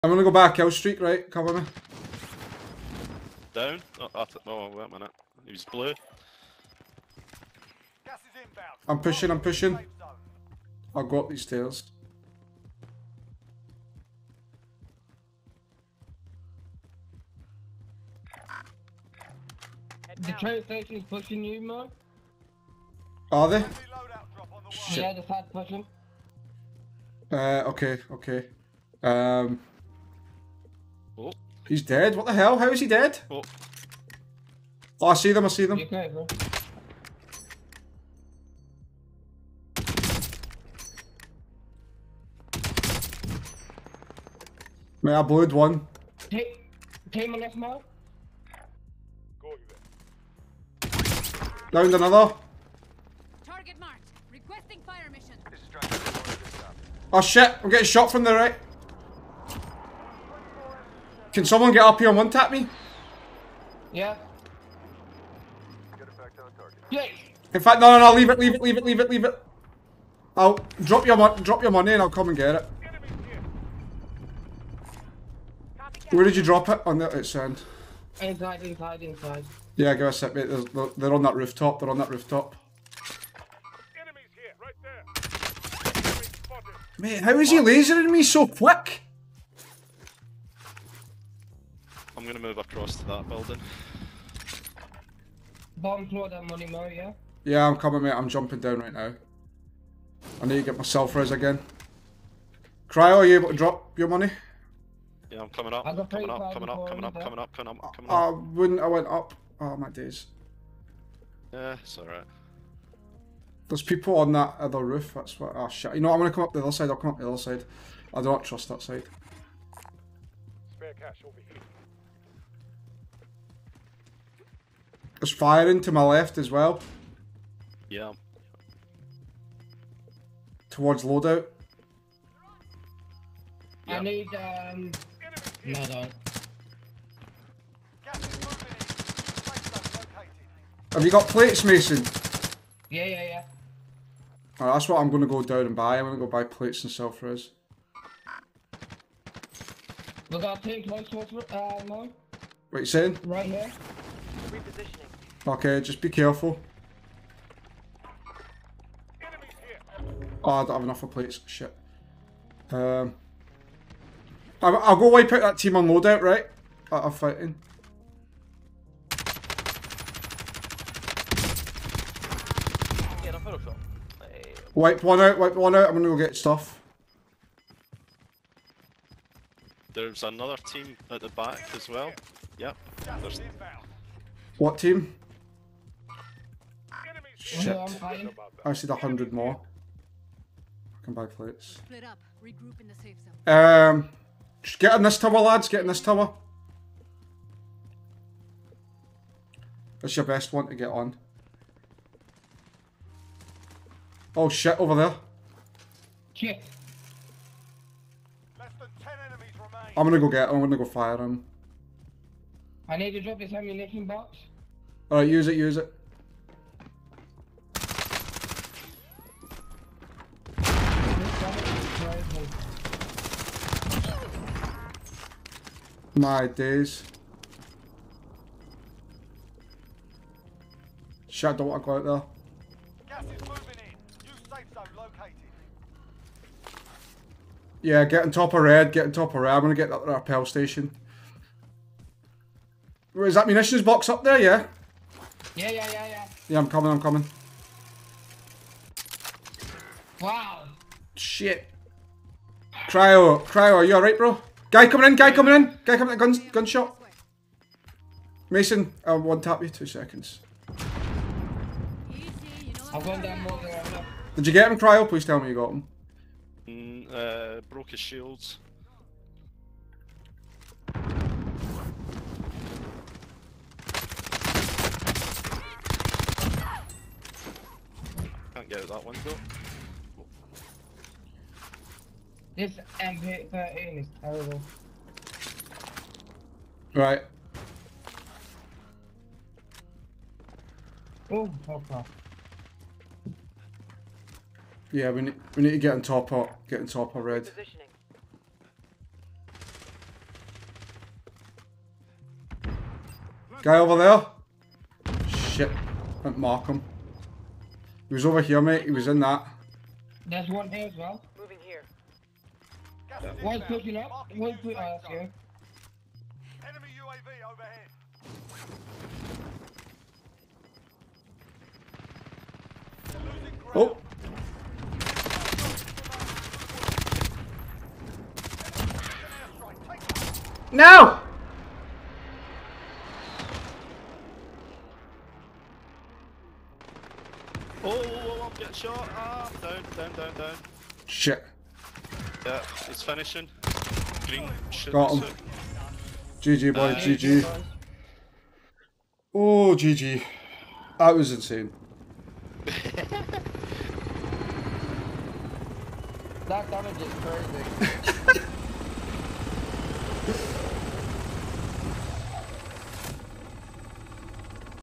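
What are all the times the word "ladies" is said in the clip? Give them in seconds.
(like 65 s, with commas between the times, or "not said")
not said.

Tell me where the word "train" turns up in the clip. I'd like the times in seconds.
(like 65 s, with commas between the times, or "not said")
20 s.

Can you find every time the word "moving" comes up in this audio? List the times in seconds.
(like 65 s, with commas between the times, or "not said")
233 s.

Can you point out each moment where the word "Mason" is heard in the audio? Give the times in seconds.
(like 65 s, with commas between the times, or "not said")
141 s, 258 s.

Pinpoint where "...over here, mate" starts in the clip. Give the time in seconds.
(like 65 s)
308 s.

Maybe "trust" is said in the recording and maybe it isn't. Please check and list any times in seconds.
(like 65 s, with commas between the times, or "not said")
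118 s.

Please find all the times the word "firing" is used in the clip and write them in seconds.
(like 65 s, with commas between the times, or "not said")
125 s.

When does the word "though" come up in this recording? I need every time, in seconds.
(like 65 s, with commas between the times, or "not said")
279 s.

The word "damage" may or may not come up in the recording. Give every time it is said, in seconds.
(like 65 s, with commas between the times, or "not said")
356 s.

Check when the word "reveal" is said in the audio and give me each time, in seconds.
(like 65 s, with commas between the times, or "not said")
not said.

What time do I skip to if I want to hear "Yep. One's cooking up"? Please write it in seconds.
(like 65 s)
313 s.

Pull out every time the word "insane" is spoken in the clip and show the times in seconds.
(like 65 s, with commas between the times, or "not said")
351 s.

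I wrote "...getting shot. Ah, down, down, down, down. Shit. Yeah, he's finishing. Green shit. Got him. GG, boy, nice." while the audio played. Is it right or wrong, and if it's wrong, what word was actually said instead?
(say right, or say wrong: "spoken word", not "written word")
right.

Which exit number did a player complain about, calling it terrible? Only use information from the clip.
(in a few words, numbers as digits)
13.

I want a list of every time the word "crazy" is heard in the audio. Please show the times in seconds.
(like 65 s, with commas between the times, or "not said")
358 s.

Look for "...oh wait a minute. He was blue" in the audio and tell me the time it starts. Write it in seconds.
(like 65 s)
4 s.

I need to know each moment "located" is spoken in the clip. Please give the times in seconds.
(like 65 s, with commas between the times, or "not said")
234 s.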